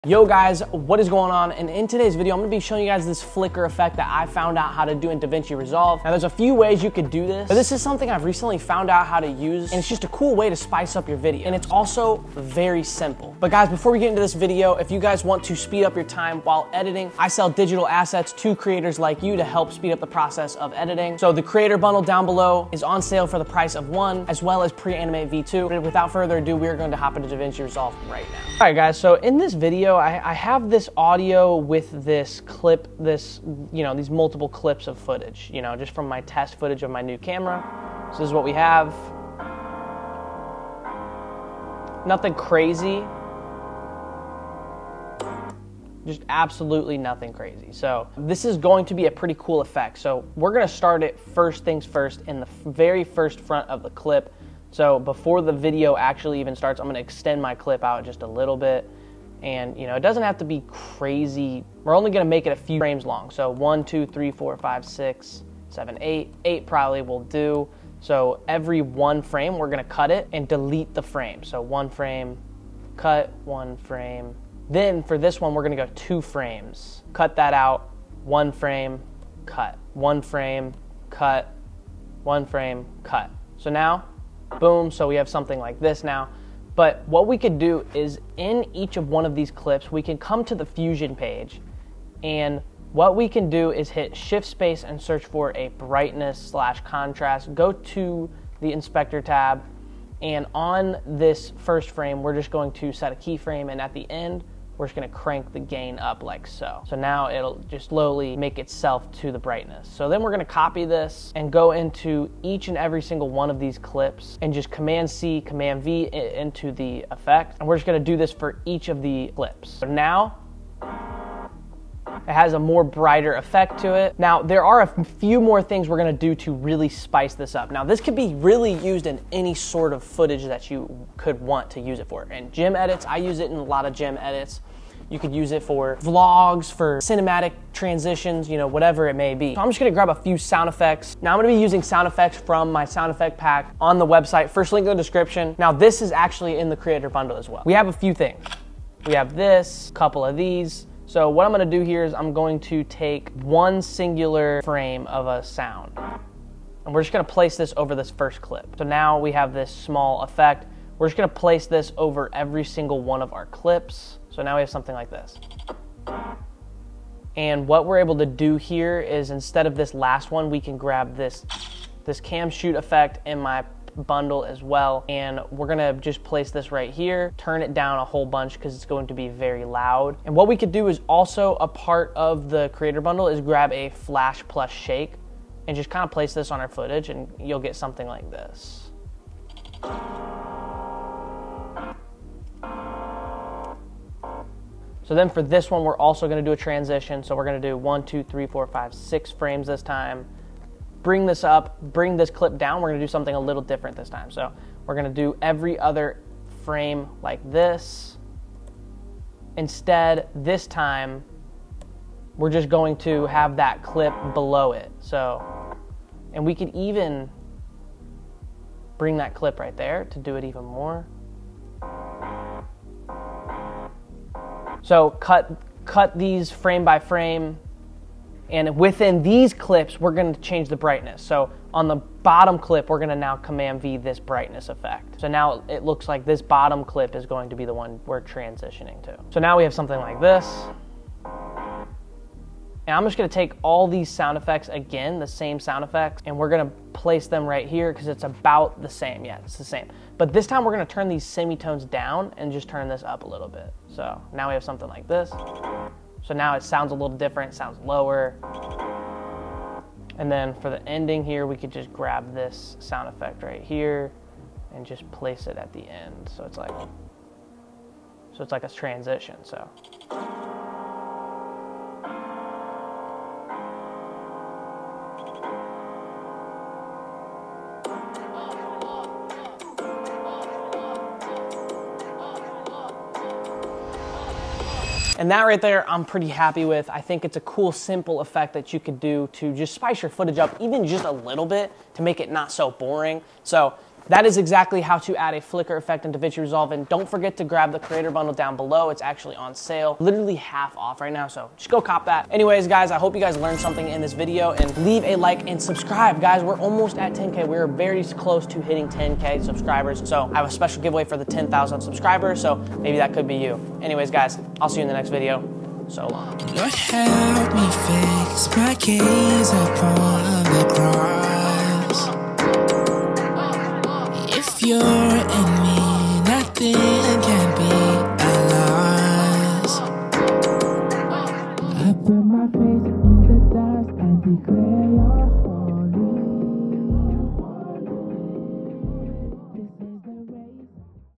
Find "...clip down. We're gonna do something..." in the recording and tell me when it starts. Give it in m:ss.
3:22.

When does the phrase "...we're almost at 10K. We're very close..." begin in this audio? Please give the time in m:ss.
5:06.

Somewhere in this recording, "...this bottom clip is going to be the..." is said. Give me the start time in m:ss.
3:56.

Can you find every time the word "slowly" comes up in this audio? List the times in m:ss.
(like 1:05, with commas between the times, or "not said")
1:47.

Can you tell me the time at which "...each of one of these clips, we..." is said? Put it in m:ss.
1:28.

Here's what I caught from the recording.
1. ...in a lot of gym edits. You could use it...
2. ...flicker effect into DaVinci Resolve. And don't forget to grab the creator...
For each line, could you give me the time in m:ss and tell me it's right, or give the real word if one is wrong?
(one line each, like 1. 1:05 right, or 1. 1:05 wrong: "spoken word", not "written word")
1. 2:13 right
2. 4:55 right.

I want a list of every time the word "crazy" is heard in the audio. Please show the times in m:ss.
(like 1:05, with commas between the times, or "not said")
0:42, 0:47, 1:00.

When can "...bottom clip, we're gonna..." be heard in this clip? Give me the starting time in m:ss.
3:51.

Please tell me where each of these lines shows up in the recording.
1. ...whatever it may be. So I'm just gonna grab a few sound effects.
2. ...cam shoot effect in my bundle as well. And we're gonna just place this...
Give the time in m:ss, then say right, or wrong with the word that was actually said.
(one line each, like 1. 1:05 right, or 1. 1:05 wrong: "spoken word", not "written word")
1. 2:18 right
2. 2:52 right.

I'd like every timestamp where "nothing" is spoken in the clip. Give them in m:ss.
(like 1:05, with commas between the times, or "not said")
0:42, 0:46.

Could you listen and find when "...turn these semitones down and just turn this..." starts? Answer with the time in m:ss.
4:10.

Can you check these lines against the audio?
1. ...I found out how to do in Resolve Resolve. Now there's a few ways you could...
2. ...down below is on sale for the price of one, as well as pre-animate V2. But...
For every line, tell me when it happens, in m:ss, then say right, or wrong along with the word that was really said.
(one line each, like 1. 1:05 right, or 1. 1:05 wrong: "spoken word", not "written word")
1. 0:04 wrong: "DaVinci", not "Resolve"
2. 0:22 right.